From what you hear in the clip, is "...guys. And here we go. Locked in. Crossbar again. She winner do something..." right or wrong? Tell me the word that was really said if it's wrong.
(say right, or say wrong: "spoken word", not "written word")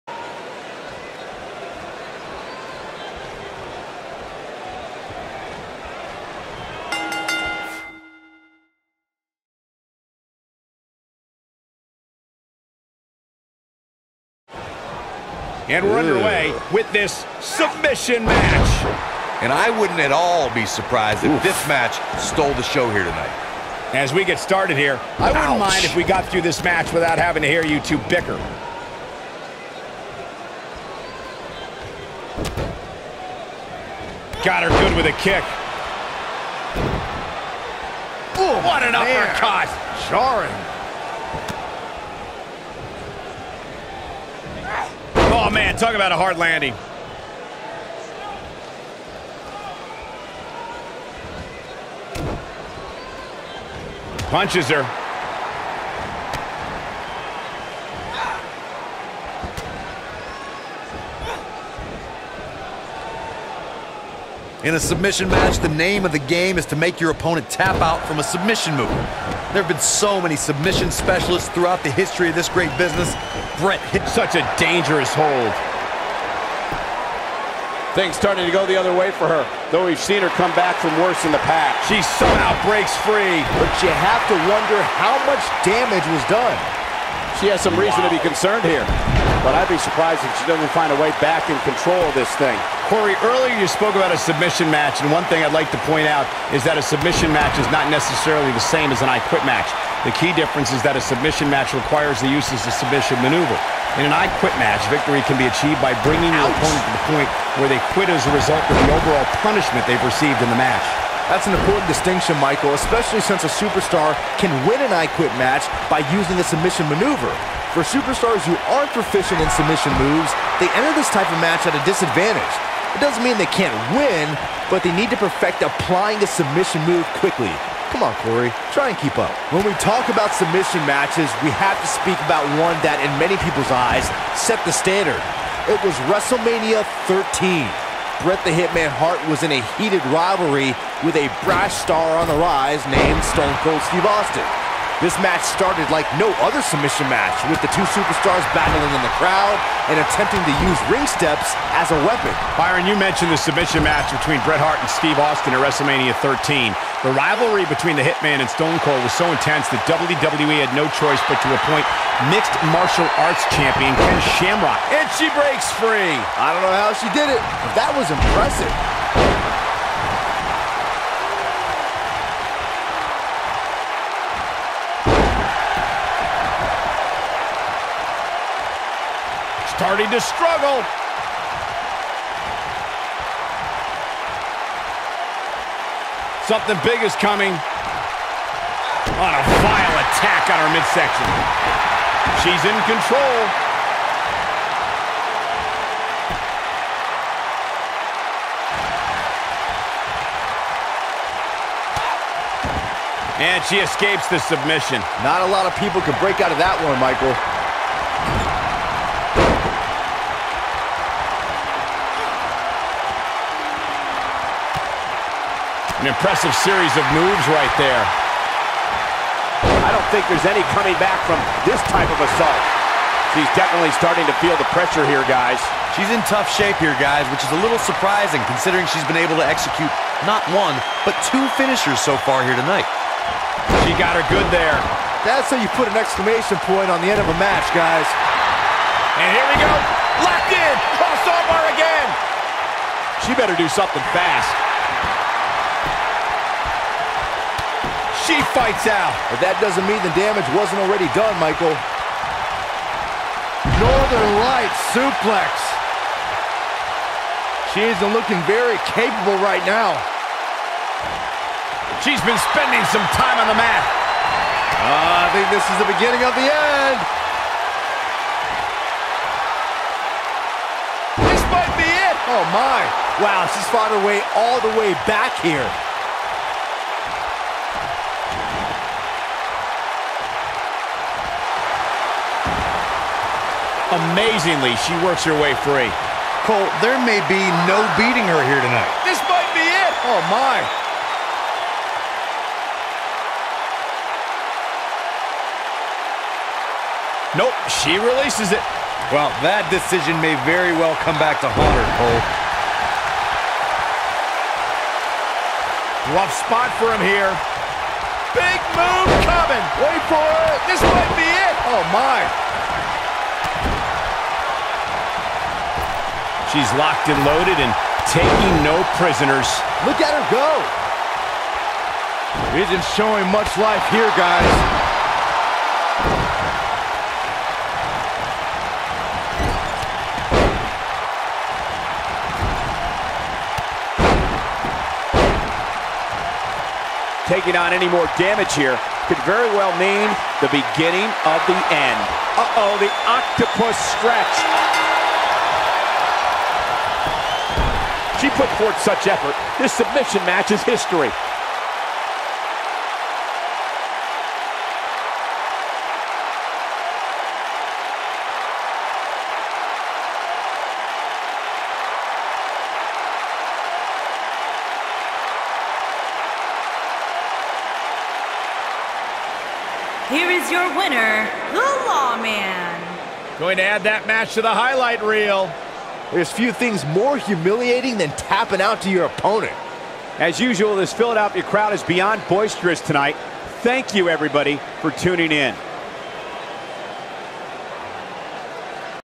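wrong: "better", not "winner".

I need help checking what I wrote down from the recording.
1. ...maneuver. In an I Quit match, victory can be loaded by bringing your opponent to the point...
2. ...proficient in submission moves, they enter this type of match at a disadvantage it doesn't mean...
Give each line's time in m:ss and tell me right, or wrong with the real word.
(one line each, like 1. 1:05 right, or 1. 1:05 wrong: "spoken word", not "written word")
1. 1:43 wrong: "achieved", not "loaded"
2. 1:58 right.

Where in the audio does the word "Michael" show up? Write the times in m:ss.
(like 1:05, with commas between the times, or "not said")
1:52, 3:26, 4:11.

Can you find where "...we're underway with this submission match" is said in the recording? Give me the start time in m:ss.
0:15.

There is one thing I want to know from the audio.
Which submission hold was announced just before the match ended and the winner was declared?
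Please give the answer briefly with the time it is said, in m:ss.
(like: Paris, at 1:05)
Octopus stretch, at 5:43.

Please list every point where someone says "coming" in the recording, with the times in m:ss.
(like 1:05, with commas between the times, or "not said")
3:07, 3:40, 5:09.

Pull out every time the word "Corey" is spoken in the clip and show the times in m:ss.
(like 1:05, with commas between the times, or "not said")
1:32, 2:08.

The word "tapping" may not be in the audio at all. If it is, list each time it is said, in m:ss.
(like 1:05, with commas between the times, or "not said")
6:18.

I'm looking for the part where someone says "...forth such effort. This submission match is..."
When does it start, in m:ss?
5:48.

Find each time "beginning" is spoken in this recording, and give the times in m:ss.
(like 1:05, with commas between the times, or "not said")
4:25, 5:40.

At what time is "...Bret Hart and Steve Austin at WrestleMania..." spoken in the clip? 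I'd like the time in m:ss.
2:34.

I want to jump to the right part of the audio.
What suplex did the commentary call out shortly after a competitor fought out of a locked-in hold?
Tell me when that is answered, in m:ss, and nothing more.
4:13.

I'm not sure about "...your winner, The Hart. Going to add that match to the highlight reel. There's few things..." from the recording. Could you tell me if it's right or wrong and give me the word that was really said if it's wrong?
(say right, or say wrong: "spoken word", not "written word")
wrong: "Lawman", not "Hart".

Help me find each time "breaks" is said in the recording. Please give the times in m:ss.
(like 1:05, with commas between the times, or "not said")
1:22, 2:45, 3:26.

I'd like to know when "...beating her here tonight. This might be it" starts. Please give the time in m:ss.
4:47.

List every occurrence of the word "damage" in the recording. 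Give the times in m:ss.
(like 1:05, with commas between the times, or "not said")
1:25, 4:10, 5:38.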